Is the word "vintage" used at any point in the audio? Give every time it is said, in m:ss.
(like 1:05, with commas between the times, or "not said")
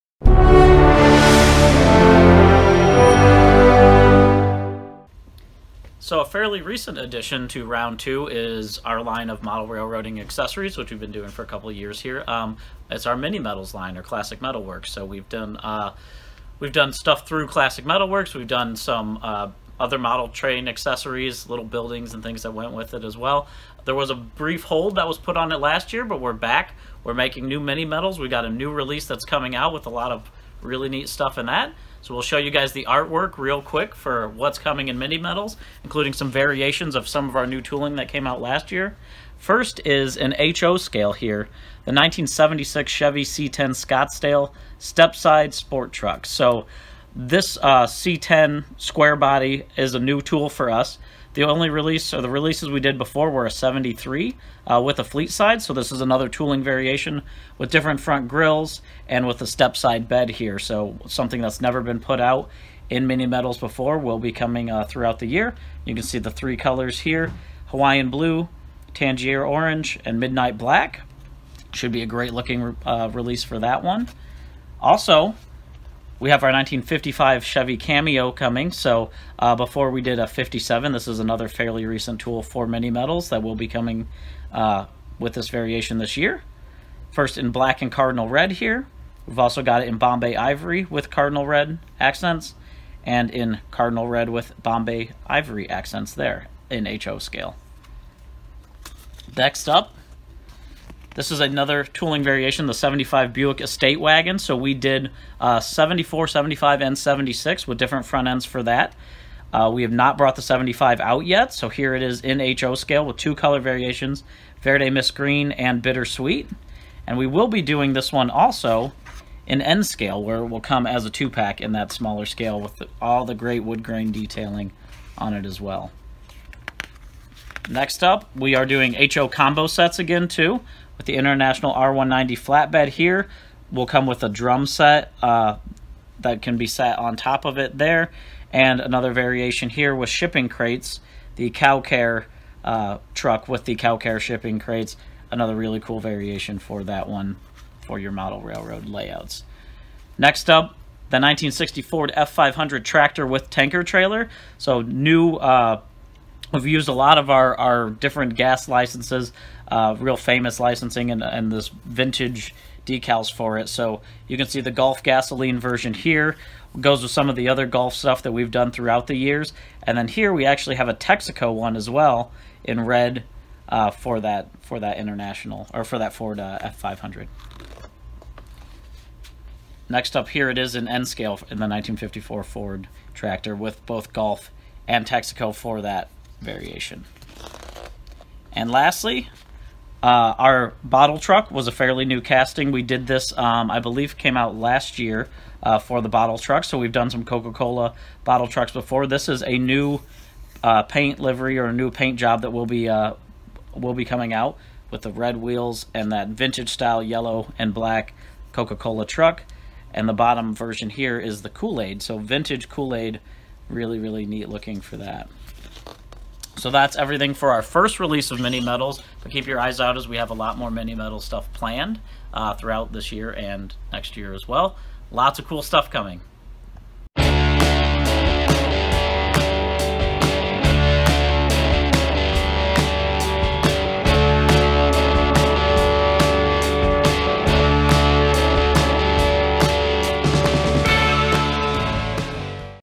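2:41, 3:26, 3:32.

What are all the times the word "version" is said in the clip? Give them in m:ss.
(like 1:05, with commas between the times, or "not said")
2:45, 3:30.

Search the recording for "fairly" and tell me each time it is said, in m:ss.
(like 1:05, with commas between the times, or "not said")
0:06, 1:21, 3:11.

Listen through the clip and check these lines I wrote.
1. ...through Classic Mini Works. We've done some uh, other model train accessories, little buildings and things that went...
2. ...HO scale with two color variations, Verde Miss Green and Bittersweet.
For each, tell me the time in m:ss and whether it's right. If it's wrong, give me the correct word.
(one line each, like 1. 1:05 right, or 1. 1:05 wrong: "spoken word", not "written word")
1. 0:17 wrong: "Metal", not "Mini"
2. 1:52 right.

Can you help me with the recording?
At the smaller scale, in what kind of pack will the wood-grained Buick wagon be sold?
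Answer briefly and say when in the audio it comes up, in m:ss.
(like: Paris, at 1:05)
Two-pack, at 2:01.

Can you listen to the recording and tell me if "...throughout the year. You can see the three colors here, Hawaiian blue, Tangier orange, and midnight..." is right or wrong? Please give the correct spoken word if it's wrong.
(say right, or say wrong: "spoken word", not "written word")
right.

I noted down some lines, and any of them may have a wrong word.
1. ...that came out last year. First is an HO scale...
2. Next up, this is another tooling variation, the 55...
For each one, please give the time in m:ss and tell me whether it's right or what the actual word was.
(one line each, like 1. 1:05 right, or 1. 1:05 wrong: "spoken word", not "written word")
1. 0:37 right
2. 1:39 wrong: "75", not "55".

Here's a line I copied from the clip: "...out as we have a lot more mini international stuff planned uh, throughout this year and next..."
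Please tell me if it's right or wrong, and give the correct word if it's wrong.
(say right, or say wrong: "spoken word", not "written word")
wrong: "metal", not "international".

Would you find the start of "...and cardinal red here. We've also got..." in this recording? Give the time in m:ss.
1:27.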